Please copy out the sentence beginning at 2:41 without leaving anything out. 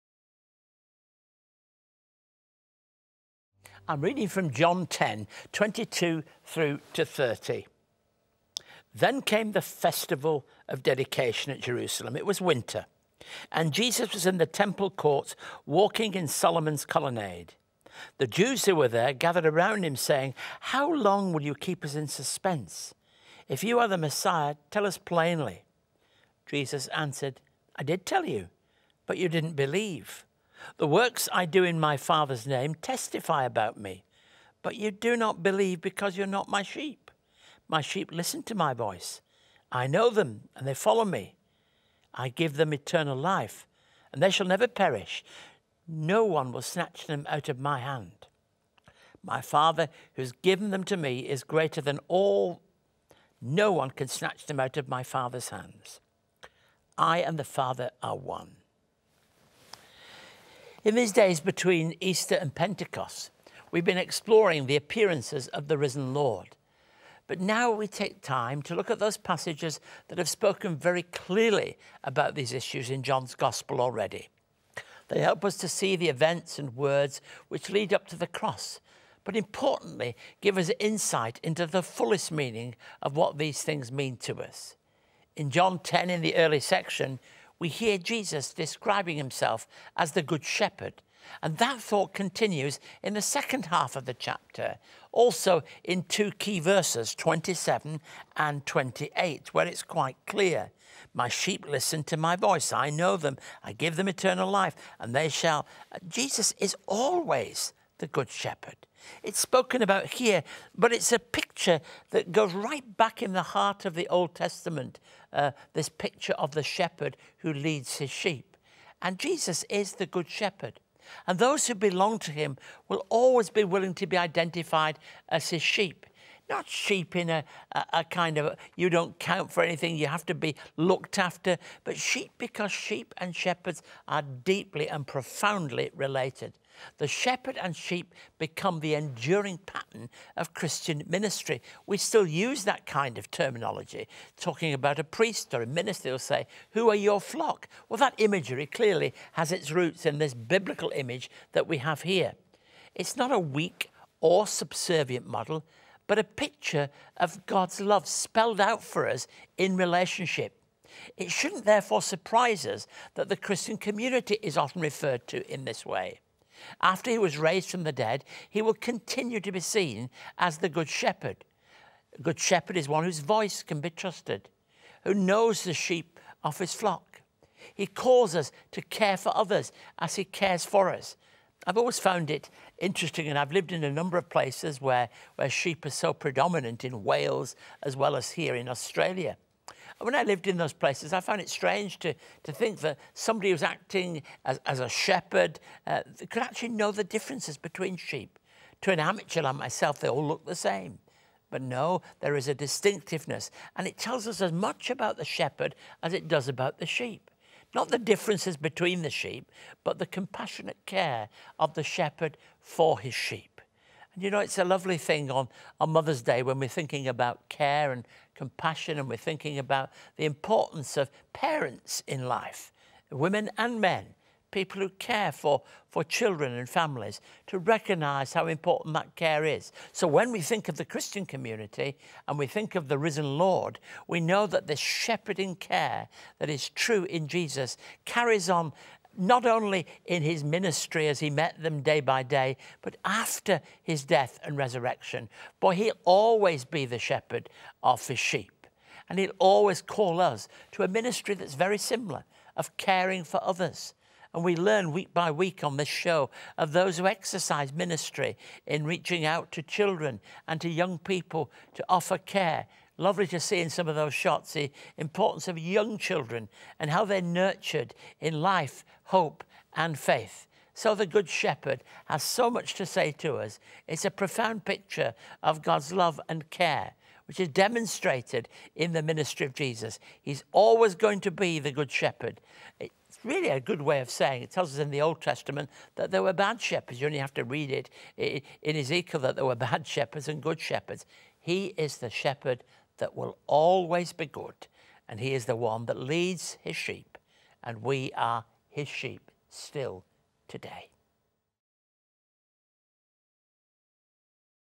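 It shouldn't therefore surprise us that the Christian community is often referred to in this way.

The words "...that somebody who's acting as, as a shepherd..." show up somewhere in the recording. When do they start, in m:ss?
3:12.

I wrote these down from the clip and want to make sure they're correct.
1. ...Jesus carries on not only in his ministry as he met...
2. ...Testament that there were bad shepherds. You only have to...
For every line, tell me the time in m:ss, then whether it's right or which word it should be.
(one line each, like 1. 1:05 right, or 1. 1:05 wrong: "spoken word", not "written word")
1. 3:57 right
2. 4:45 right.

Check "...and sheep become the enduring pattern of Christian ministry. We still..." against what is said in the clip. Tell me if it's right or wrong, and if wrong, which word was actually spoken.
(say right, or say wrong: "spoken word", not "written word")
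right.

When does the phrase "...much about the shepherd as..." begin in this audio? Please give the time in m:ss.
3:24.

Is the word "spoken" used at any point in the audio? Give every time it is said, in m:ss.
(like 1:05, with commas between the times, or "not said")
1:10, 1:49.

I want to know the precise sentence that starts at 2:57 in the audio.
He calls us to care for others as he cares for us.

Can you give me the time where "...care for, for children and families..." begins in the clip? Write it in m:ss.
3:44.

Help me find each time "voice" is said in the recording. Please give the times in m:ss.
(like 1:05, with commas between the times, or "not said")
0:38, 1:42, 2:53.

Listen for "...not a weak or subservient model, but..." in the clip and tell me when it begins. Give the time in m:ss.
2:33.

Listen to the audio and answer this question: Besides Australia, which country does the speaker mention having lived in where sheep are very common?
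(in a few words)
Wales.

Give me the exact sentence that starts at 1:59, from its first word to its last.
And Jesus is the Good Shepherd.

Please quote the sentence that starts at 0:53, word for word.
No one can snatch them out of my Father's hands.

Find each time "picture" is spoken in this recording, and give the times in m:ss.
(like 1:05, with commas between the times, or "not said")
1:51, 1:55, 2:36, 4:34.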